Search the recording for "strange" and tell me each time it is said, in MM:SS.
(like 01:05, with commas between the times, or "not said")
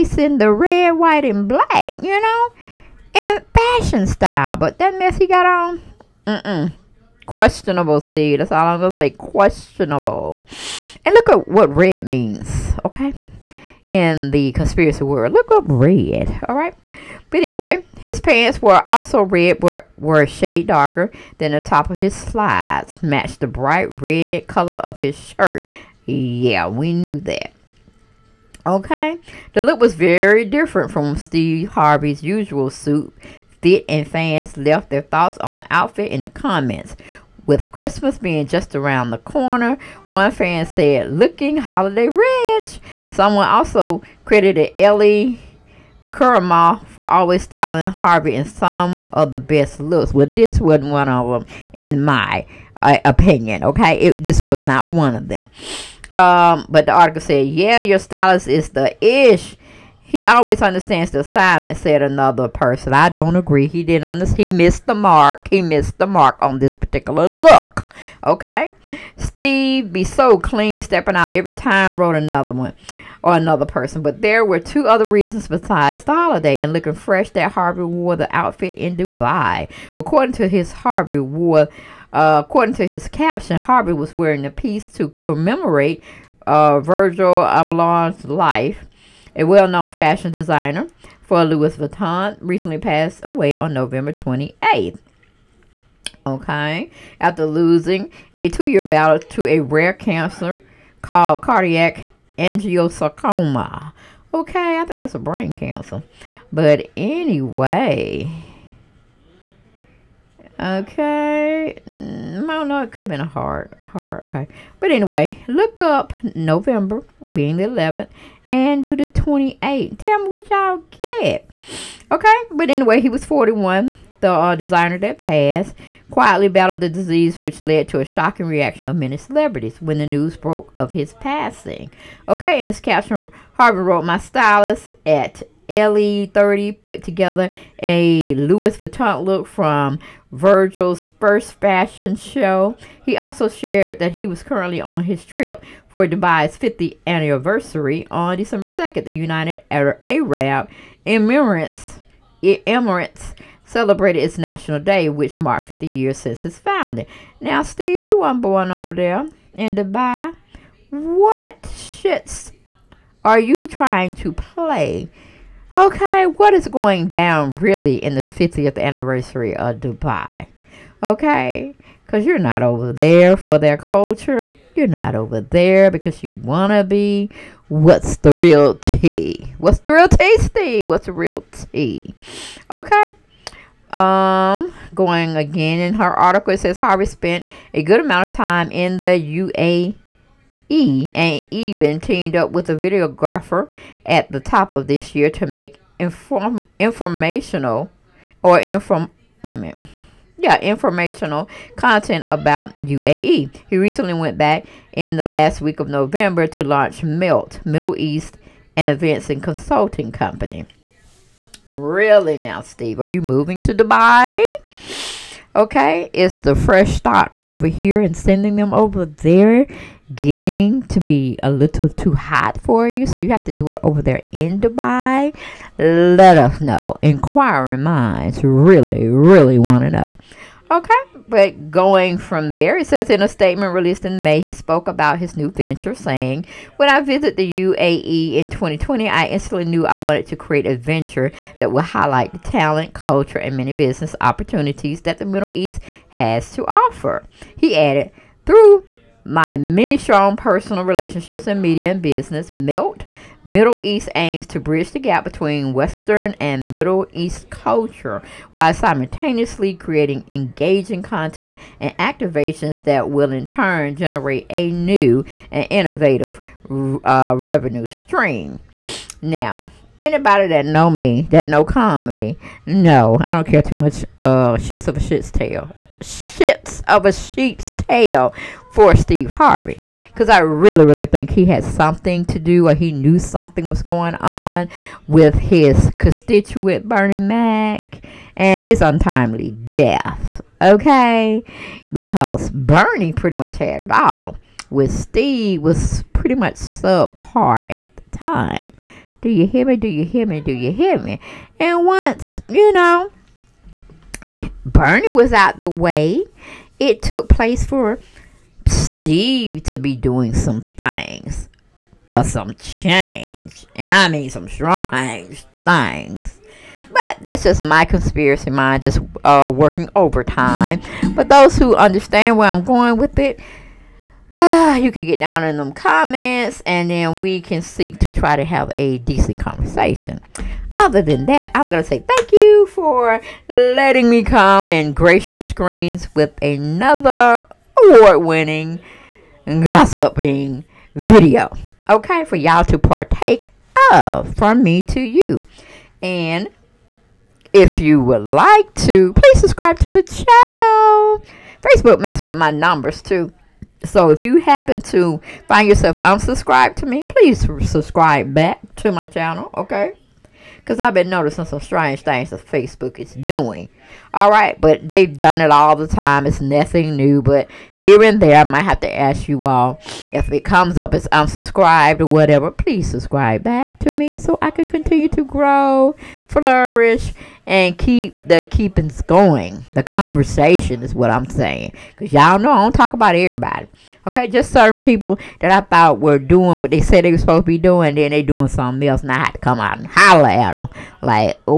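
05:14, 06:01.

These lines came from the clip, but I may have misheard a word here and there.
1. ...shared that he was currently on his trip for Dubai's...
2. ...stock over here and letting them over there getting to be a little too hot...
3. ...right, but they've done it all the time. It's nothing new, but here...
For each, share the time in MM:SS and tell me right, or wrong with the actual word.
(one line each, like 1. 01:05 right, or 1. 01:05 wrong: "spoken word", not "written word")
1. 02:23 right
2. 03:36 wrong: "sending", not "letting"
3. 06:04 right.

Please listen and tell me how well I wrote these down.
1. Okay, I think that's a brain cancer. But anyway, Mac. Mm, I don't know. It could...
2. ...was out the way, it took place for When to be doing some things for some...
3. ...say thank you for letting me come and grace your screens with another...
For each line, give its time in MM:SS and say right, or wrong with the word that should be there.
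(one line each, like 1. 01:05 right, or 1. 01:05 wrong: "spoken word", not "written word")
1. 01:44 wrong: "Okay", not "Mac"
2. 05:05 wrong: "Steve", not "When"
3. 05:31 right.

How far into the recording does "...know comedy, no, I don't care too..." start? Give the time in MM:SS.
04:31.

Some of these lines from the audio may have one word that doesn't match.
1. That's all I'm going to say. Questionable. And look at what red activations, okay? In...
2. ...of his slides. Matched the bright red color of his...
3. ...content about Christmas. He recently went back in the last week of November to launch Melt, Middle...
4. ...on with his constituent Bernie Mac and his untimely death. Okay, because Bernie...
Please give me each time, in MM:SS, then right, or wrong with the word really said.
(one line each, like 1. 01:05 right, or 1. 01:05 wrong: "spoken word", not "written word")
1. 00:08 wrong: "means", not "activations"
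2. 00:21 right
3. 03:21 wrong: "UAE", not "Christmas"
4. 04:44 right.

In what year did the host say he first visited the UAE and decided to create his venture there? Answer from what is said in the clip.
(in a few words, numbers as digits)
2020.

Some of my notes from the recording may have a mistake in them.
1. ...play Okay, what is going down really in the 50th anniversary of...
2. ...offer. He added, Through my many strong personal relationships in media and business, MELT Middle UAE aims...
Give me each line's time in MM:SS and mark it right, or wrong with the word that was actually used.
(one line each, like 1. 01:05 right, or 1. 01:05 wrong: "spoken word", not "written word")
1. 02:44 right
2. 04:06 wrong: "East", not "UAE".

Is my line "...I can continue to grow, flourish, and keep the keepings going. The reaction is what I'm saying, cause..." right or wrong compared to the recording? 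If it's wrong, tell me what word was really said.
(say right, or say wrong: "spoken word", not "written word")
wrong: "conversation", not "reaction".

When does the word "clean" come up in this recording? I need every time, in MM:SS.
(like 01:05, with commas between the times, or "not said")
01:10.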